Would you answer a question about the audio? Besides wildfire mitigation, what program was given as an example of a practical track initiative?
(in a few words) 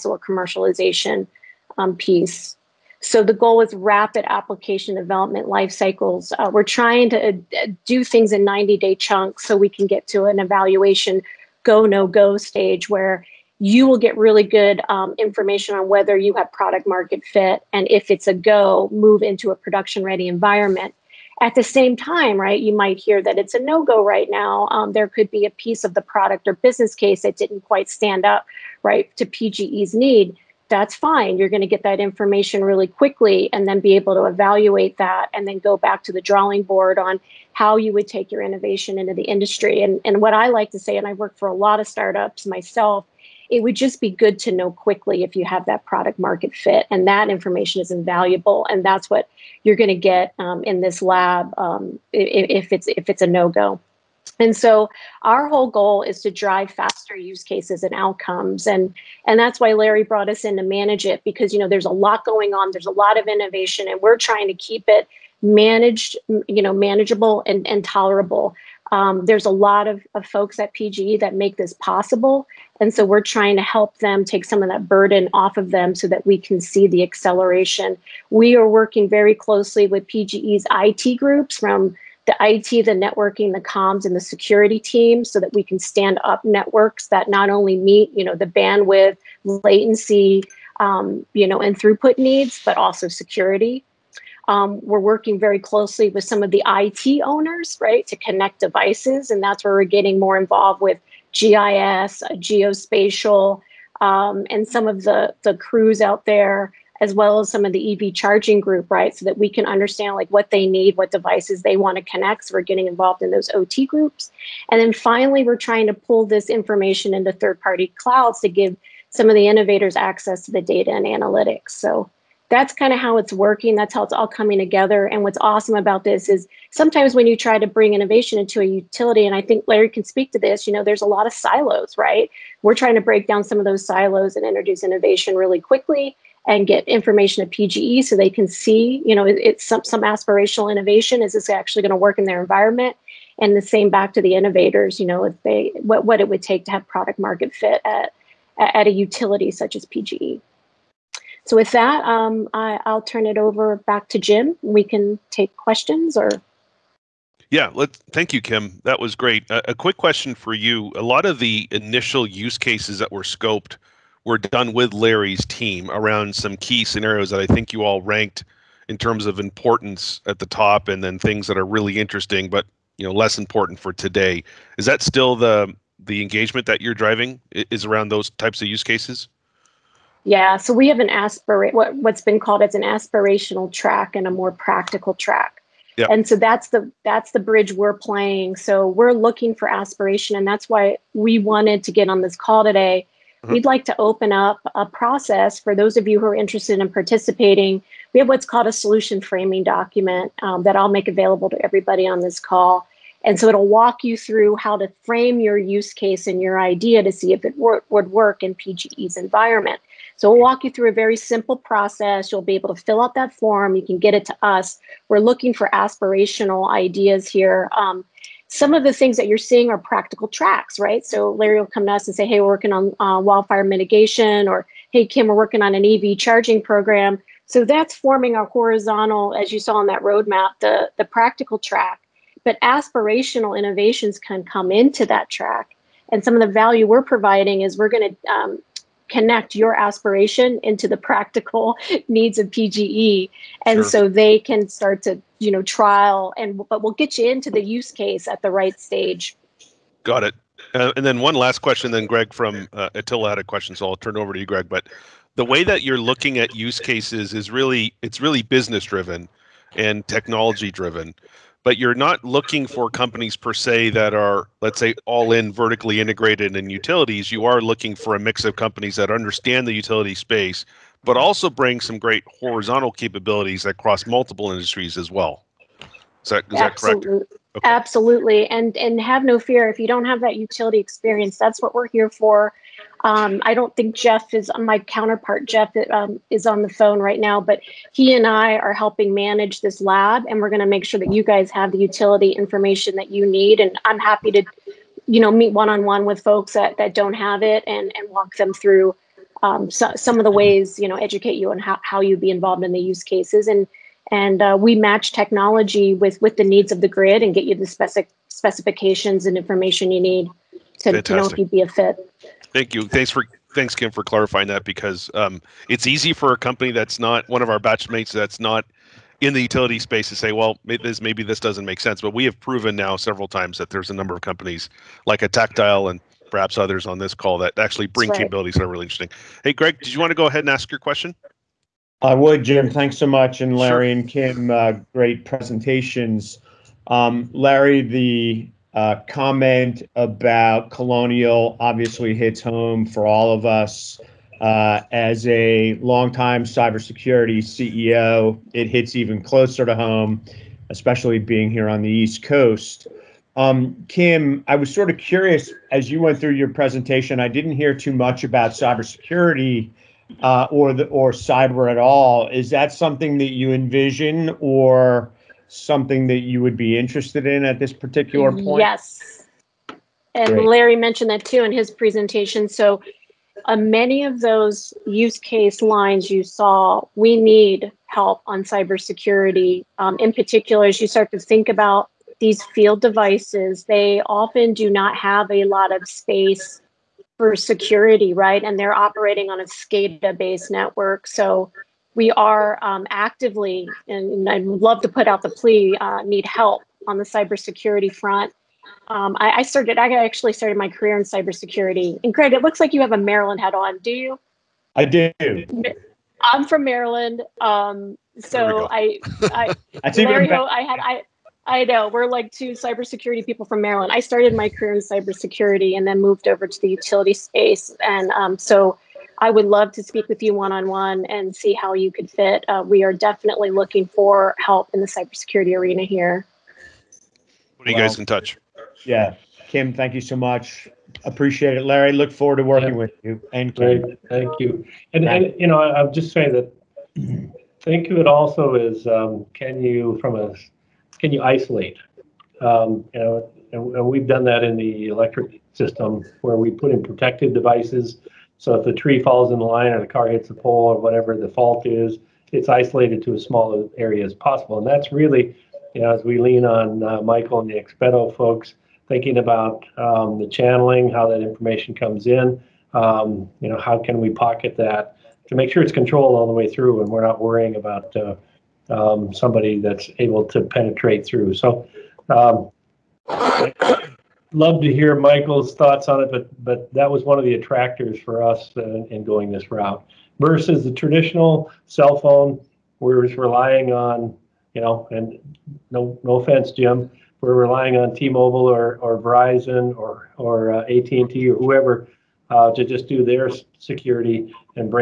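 EV charging program.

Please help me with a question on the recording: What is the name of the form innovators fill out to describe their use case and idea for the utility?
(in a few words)
Solution framing document.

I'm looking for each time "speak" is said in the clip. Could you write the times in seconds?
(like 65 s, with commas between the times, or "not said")
130 s, 419 s.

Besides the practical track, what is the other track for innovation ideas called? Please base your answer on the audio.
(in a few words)
Aspirational track.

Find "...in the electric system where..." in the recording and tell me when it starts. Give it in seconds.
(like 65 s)
444 s.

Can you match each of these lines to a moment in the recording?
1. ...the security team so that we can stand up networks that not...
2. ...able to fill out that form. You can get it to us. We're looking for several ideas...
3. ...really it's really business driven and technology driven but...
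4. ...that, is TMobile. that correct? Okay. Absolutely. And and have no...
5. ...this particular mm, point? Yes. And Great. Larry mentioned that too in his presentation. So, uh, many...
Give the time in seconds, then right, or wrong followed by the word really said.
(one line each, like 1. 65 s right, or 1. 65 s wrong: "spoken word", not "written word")
1. 84 s right
2. 212 s wrong: "aspirational", not "several"
3. 257 s right
4. 276 s wrong: "Absolutely", not "TMobile"
5. 367 s right.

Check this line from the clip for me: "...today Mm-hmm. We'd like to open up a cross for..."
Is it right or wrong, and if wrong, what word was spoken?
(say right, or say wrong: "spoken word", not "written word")
wrong: "process", not "cross".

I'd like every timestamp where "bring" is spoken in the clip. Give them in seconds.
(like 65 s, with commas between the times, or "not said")
127 s, 271 s, 327 s.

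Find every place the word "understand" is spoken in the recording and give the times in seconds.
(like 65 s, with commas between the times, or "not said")
109 s, 269 s.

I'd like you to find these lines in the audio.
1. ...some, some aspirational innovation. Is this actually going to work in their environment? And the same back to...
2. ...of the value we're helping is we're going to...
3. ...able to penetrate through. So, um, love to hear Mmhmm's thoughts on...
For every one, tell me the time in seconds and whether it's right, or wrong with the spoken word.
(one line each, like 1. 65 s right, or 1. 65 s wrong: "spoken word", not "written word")
1. 139 s right
2. 236 s wrong: "providing", not "helping"
3. 469 s wrong: "Michael", not "Mmhmm".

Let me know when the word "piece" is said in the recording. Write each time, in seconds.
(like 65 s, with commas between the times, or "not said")
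1 s, 25 s.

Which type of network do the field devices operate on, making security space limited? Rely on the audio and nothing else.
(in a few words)
SCADA.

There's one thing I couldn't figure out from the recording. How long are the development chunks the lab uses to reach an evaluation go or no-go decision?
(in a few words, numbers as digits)
90 days.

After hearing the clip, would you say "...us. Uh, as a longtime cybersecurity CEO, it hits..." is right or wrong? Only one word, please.
right.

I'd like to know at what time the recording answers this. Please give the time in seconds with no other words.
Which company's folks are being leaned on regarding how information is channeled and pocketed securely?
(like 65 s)
457 s.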